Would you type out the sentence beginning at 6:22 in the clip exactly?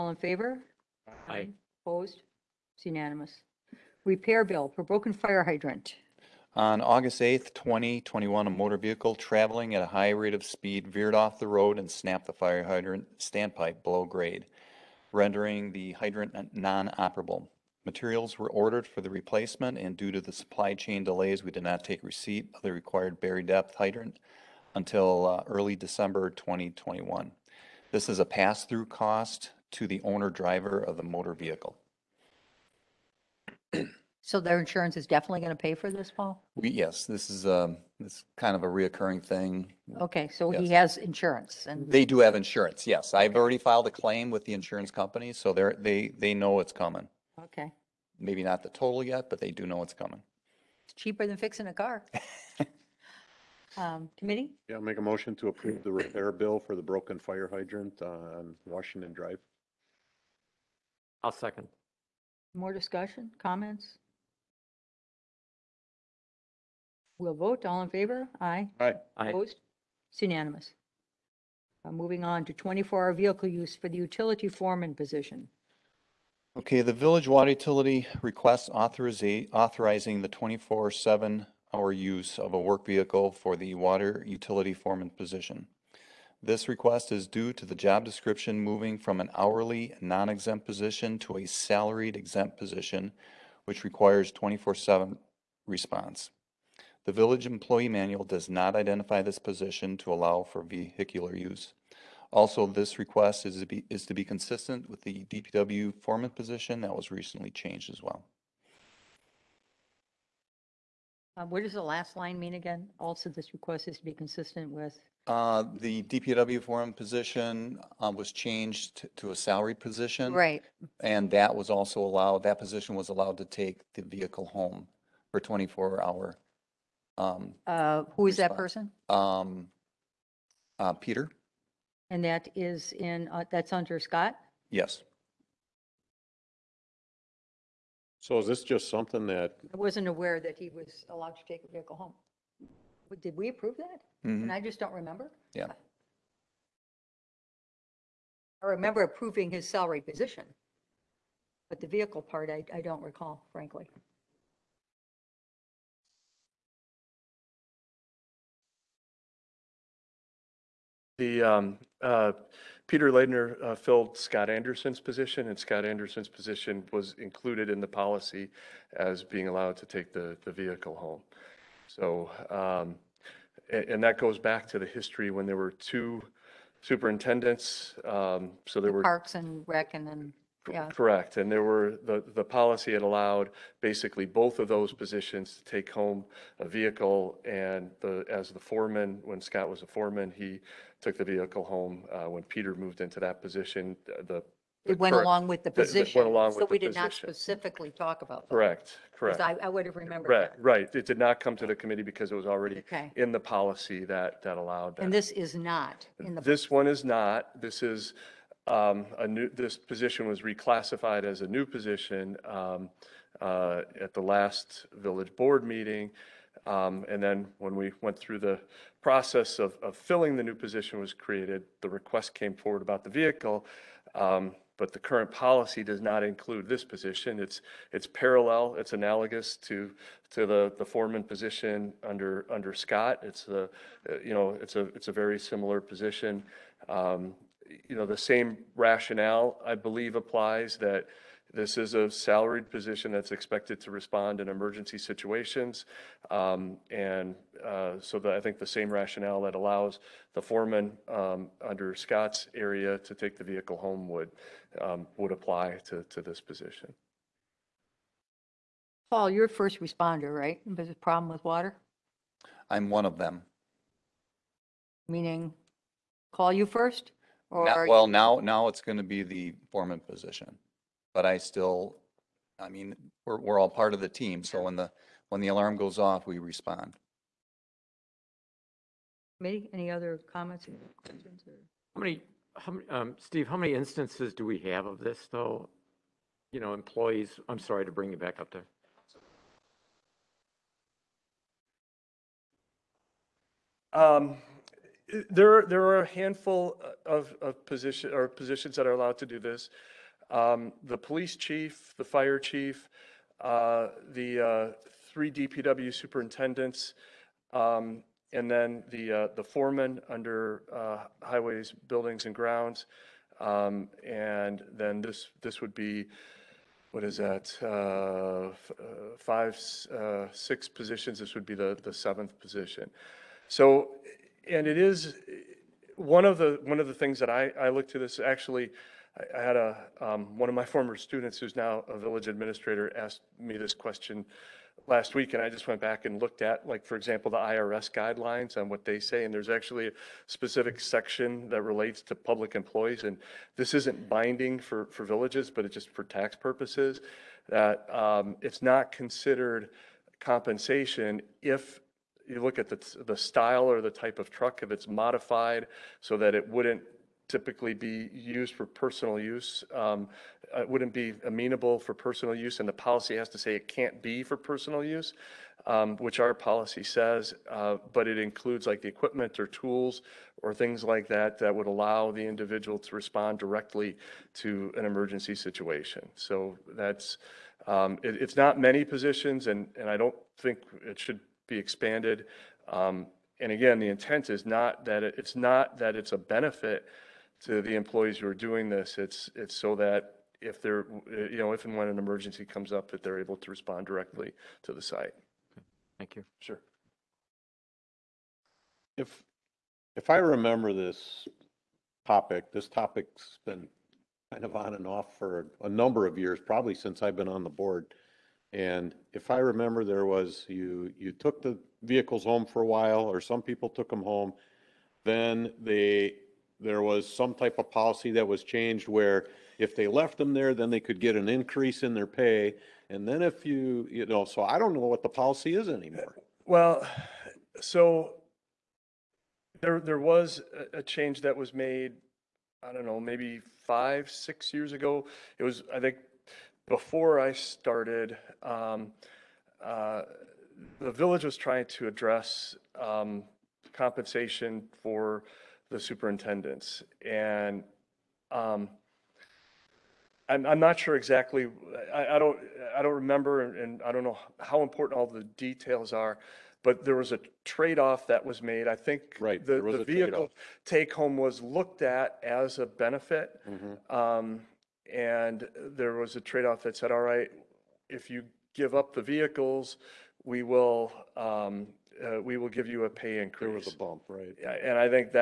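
Um, and again, the intent is not that it, it's not that it's a benefit to the employees who are doing this.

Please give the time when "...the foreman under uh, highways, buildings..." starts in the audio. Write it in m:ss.
5:09.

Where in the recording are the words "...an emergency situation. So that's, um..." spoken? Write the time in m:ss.
6:14.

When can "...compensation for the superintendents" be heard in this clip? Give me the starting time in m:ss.
7:23.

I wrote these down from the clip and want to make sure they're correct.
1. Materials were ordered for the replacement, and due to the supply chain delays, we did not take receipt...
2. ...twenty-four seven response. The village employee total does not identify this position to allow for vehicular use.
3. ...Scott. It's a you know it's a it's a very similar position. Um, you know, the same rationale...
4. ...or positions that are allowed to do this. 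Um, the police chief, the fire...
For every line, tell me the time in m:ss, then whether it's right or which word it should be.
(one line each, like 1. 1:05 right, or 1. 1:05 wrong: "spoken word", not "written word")
1. 0:17 right
2. 1:34 wrong: "manual", not "total"
3. 3:52 right
4. 4:58 right.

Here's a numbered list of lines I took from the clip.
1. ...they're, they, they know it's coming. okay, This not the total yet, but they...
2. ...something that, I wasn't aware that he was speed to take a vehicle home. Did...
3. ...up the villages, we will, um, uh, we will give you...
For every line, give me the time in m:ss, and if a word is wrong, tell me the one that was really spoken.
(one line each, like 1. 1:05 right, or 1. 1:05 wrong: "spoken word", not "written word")
1. 0:45 wrong: "Maybe", not "This"
2. 2:18 wrong: "allowed", not "speed"
3. 7:48 wrong: "vehicles", not "villages".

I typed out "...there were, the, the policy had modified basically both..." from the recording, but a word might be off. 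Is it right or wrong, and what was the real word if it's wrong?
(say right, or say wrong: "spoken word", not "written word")
wrong: "allowed", not "modified".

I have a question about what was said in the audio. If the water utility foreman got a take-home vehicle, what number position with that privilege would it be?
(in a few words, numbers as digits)
seventh.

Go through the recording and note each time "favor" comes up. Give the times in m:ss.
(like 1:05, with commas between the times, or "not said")
0:00, 1:07.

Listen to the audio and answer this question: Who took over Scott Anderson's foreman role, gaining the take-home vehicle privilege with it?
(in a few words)
Peter Ladner.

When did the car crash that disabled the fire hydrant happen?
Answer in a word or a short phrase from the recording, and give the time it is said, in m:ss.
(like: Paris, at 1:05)
August 8th, 2021, at 0:06.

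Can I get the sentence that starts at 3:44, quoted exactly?
Um, but the current policy does not include this position.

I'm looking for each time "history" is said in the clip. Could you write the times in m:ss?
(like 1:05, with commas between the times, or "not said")
2:54.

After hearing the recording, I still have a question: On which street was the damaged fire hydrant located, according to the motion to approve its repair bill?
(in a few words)
Washington Drive.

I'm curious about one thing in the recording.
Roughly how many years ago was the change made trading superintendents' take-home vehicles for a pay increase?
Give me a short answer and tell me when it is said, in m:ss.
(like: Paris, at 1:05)
5 or 6 years, at 7:13.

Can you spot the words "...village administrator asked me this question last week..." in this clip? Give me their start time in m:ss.
5:31.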